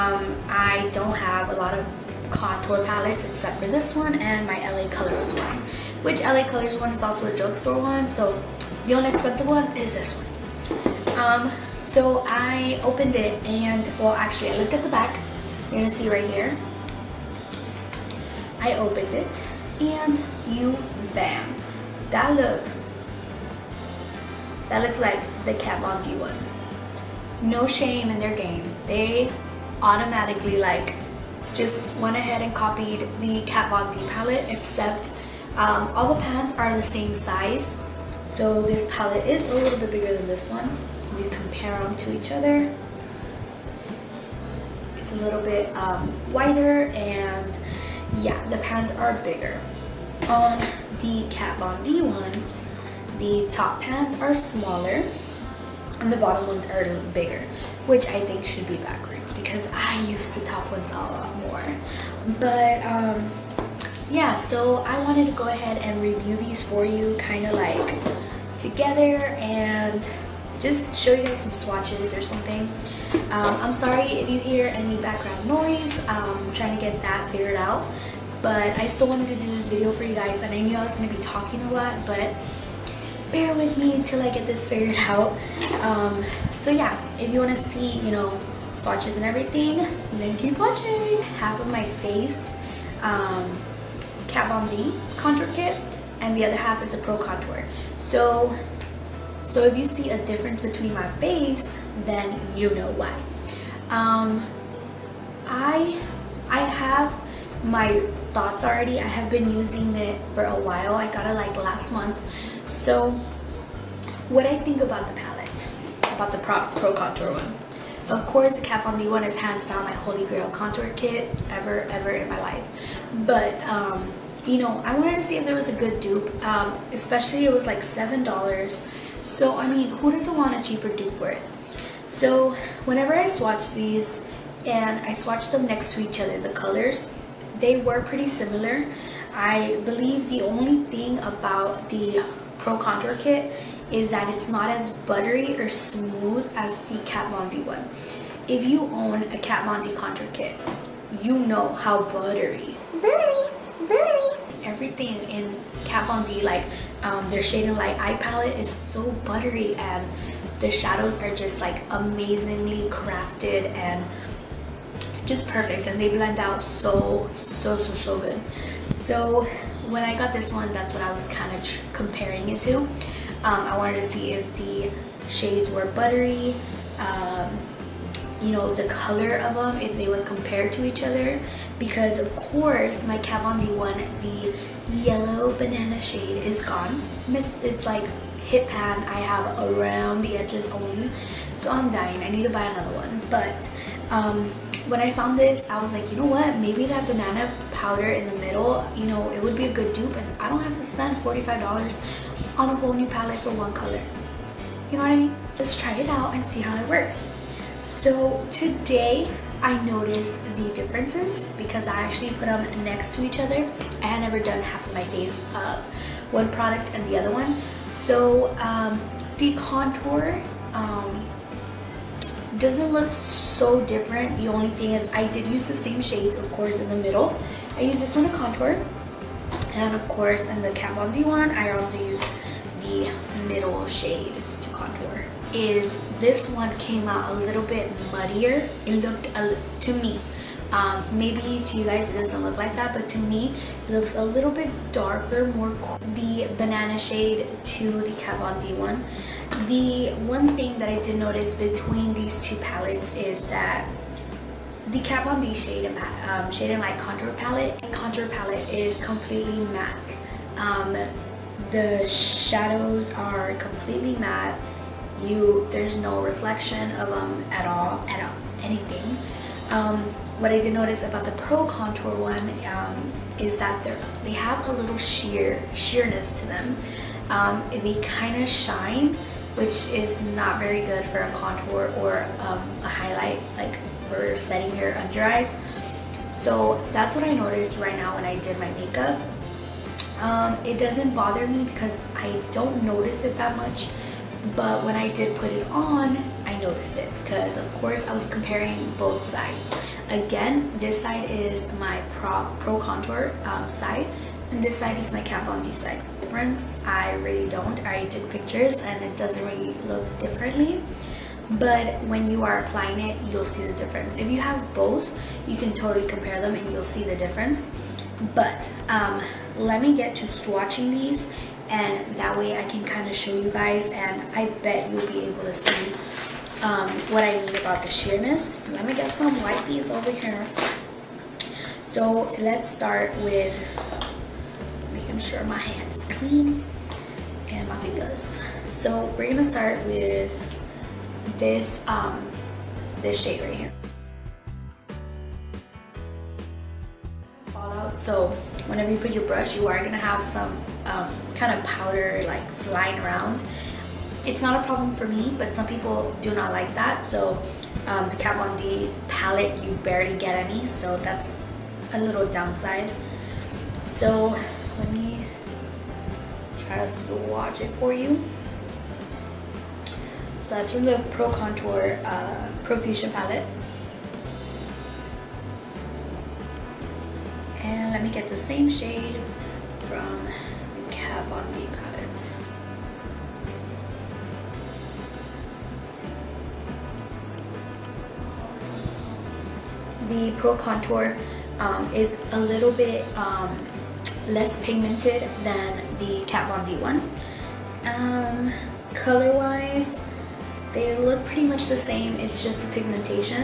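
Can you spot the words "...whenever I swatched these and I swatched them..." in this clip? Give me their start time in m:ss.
2:12.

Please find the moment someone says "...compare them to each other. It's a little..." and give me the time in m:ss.
0:41.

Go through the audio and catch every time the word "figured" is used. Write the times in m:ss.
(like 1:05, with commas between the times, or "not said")
1:17, 1:24.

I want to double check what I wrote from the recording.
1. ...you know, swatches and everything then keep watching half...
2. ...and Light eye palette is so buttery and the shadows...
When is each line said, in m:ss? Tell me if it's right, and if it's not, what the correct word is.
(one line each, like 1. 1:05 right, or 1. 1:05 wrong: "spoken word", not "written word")
1. 1:28 right
2. 2:37 right.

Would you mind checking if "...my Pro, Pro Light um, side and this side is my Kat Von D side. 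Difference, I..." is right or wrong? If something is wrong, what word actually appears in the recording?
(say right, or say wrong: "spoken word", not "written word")
wrong: "Contour", not "Light".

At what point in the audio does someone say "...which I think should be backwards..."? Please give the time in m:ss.
0:57.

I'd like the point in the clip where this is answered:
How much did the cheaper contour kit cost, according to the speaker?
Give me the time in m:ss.
2:07.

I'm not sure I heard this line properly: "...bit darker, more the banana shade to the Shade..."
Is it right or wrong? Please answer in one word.
wrong.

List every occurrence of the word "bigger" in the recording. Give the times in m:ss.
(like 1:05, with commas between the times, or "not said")
0:39, 0:49, 0:57.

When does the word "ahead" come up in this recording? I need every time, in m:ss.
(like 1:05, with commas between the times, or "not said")
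0:32, 1:05.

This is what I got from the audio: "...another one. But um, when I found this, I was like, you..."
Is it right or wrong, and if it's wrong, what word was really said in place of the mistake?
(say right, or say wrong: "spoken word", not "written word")
right.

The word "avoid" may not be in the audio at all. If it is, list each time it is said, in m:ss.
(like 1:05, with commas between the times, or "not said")
not said.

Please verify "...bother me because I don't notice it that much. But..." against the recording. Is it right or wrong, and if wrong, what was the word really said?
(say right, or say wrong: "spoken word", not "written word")
right.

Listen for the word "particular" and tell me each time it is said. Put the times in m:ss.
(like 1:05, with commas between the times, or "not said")
not said.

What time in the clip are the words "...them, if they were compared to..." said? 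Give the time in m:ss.
2:59.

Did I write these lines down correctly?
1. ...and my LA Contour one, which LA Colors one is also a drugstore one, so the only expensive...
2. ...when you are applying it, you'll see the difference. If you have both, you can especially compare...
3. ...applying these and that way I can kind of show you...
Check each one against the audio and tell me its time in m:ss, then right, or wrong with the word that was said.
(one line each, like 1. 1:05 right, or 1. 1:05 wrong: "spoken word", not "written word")
1. 0:04 wrong: "Colors", not "Contour"
2. 5:12 wrong: "totally", not "especially"
3. 5:20 wrong: "swatching", not "applying".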